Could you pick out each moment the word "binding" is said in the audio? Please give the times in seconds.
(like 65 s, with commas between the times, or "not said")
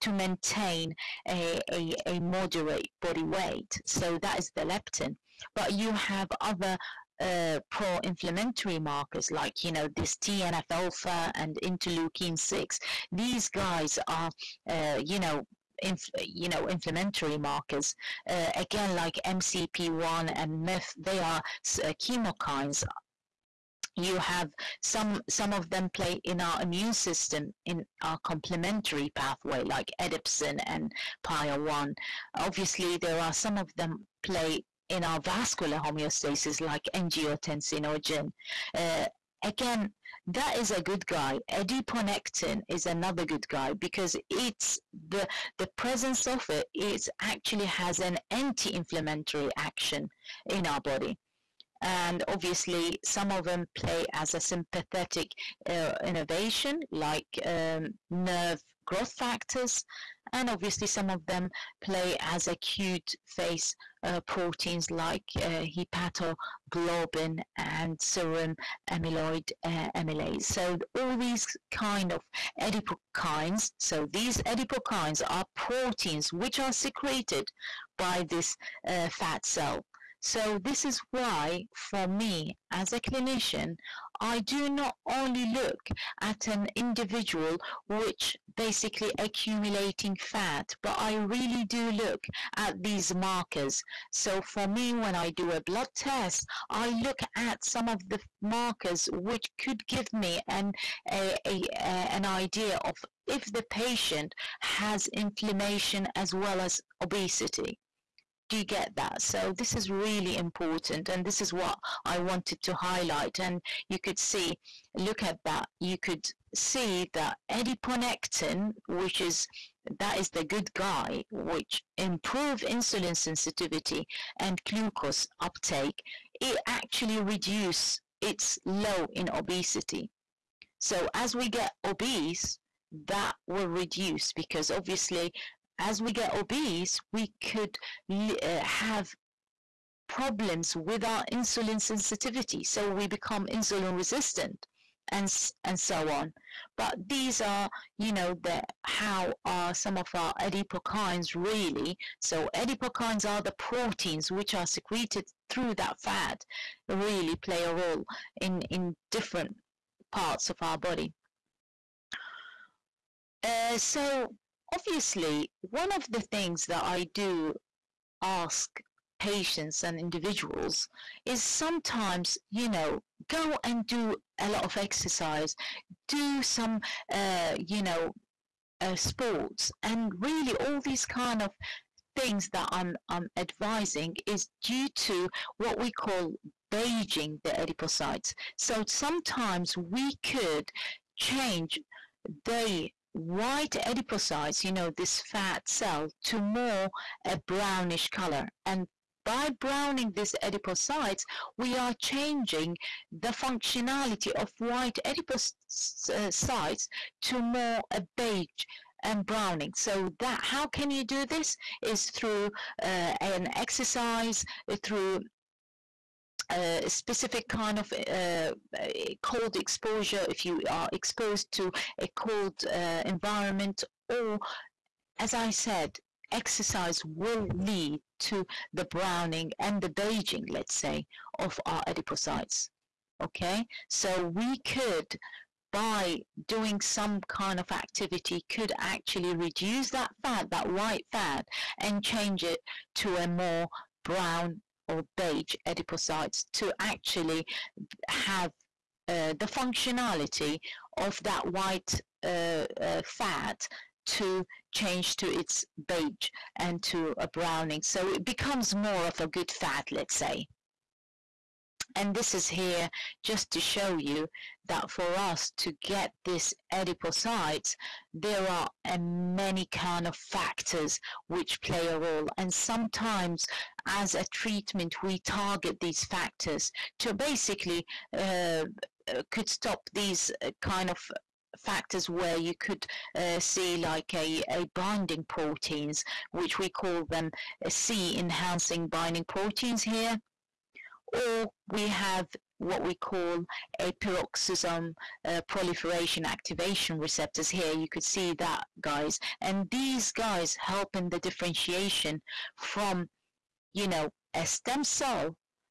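284 s, 288 s.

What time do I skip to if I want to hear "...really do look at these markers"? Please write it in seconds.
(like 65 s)
91 s.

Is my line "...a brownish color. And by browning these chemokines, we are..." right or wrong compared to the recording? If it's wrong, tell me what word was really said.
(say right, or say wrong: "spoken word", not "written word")
wrong: "adipocytes", not "chemokines".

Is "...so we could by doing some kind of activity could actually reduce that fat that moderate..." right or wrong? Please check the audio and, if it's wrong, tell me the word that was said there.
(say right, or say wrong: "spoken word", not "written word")
wrong: "white", not "moderate".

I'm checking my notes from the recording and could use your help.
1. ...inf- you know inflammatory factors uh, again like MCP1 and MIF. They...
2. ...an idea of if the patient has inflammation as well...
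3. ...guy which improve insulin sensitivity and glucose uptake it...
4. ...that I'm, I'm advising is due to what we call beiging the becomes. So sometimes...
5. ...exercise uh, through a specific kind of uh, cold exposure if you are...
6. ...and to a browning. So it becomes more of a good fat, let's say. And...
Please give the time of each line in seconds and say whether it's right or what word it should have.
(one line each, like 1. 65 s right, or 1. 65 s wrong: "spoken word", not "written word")
1. 15 s wrong: "markers", not "factors"
2. 102 s right
3. 120 s right
4. 182 s wrong: "adipocytes", not "becomes"
5. 213 s right
6. 256 s right.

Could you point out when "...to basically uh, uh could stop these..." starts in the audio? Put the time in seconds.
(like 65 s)
276 s.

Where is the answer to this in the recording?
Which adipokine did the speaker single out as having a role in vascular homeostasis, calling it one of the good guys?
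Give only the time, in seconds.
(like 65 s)
36 s.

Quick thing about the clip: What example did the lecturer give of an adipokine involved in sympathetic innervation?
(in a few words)
Nerve growth factors.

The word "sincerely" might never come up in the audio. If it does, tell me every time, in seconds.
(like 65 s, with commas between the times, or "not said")
not said.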